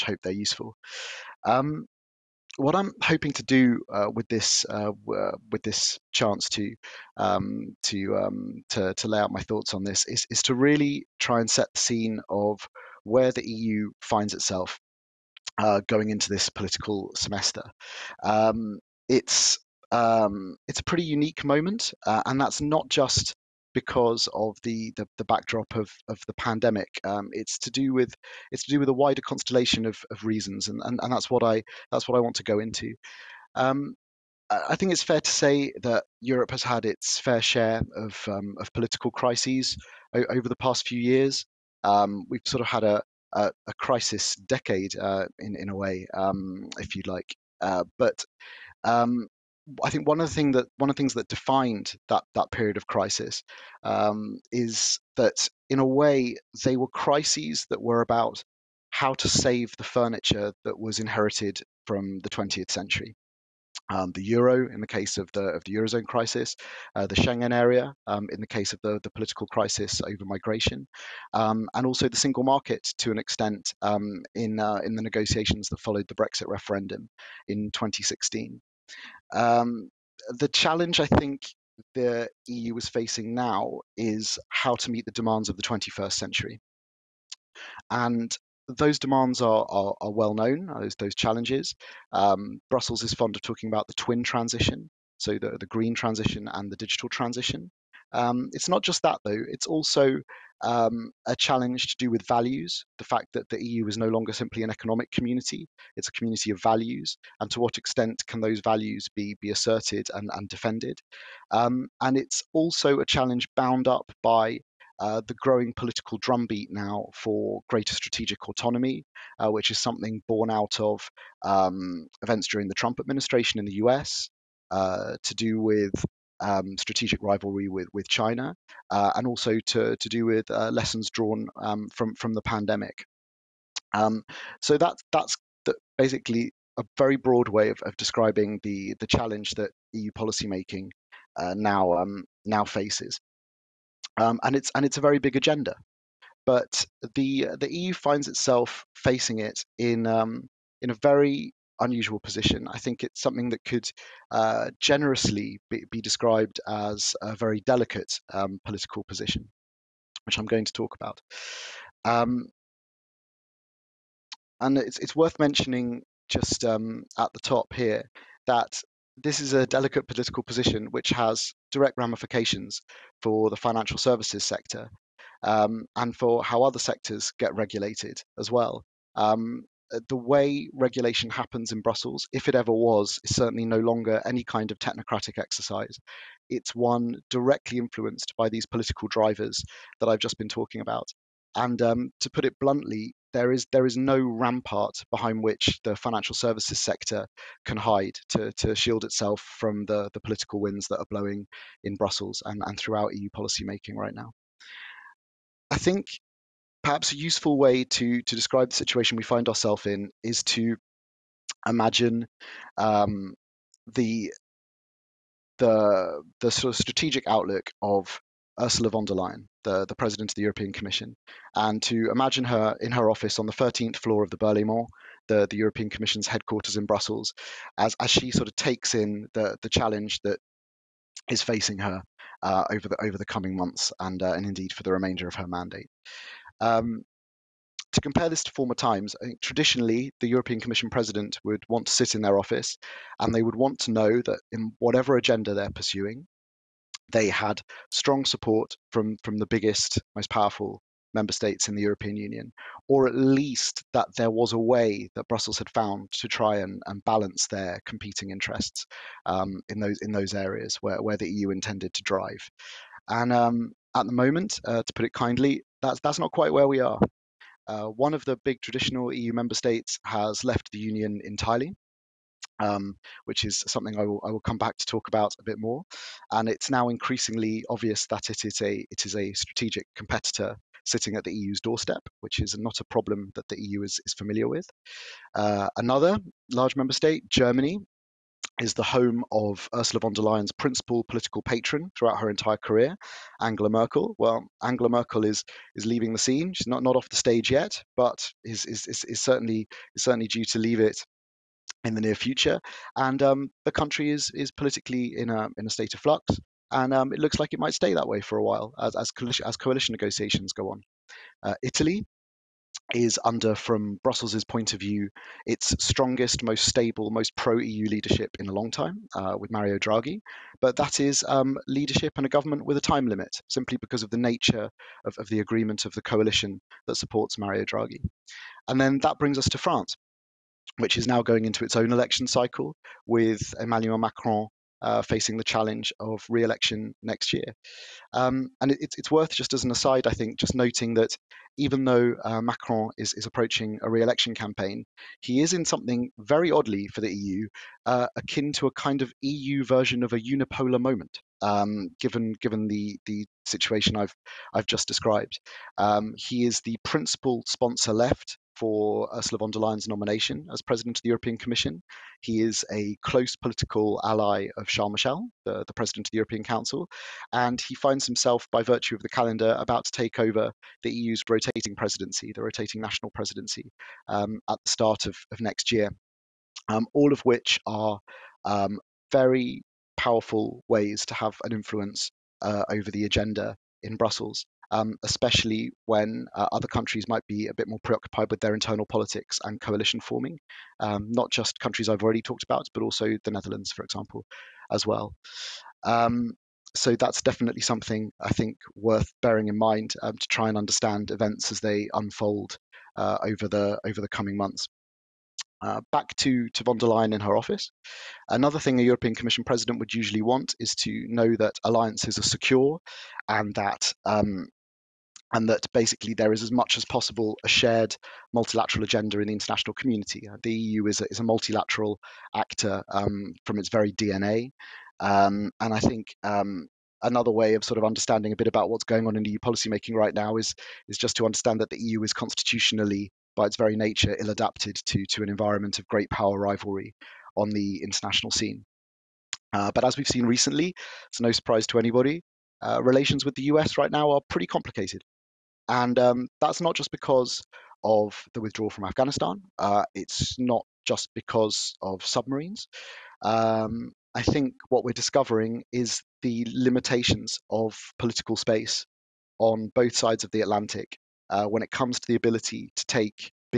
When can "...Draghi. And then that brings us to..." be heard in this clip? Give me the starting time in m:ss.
5:27.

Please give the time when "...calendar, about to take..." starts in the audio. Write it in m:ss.
6:09.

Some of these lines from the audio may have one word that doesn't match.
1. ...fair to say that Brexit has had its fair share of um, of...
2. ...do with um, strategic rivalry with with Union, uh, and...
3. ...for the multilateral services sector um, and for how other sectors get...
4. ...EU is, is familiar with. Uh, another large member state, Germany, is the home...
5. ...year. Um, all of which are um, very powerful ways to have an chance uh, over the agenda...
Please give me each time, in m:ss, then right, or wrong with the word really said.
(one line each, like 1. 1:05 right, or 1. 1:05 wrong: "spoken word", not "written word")
1. 0:35 wrong: "Europe", not "Brexit"
2. 2:05 wrong: "China", not "Union"
3. 2:53 wrong: "financial", not "multilateral"
4. 4:43 right
5. 6:15 wrong: "influence", not "chance".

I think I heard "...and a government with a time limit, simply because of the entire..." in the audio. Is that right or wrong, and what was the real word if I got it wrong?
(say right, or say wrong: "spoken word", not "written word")
wrong: "nature", not "entire".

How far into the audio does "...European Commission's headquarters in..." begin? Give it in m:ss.
3:45.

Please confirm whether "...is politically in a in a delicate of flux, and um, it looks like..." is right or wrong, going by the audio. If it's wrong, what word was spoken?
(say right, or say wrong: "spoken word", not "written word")
wrong: "state", not "delicate".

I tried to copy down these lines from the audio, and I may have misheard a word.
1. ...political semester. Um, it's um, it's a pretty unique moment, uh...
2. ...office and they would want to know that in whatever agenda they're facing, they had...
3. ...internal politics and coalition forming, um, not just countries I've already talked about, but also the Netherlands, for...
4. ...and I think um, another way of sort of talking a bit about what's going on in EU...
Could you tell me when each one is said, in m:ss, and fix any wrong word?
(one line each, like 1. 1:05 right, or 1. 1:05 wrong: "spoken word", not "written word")
1. 0:16 right
2. 4:02 wrong: "pursuing", not "facing"
3. 6:28 right
4. 7:05 wrong: "understanding", not "talking".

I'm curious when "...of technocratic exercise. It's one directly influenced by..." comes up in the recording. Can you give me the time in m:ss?
3:04.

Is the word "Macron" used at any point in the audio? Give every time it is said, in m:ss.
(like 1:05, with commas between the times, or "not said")
5:33, 5:42.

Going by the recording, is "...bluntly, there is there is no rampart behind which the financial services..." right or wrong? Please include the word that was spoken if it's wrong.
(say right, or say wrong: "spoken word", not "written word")
right.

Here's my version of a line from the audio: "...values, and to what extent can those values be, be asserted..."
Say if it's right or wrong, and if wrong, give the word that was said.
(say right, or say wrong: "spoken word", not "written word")
right.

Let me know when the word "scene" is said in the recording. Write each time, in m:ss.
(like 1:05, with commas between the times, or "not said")
0:11, 4:56, 7:18.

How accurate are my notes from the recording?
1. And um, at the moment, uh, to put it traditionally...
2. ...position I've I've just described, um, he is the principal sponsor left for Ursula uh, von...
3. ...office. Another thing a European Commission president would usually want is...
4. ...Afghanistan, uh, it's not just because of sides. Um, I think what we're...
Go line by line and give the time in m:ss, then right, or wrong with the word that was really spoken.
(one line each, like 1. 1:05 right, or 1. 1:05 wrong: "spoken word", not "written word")
1. 4:23 wrong: "kindly", not "traditionally"
2. 5:53 wrong: "situation", not "position"
3. 6:47 right
4. 7:28 wrong: "submarines", not "sides".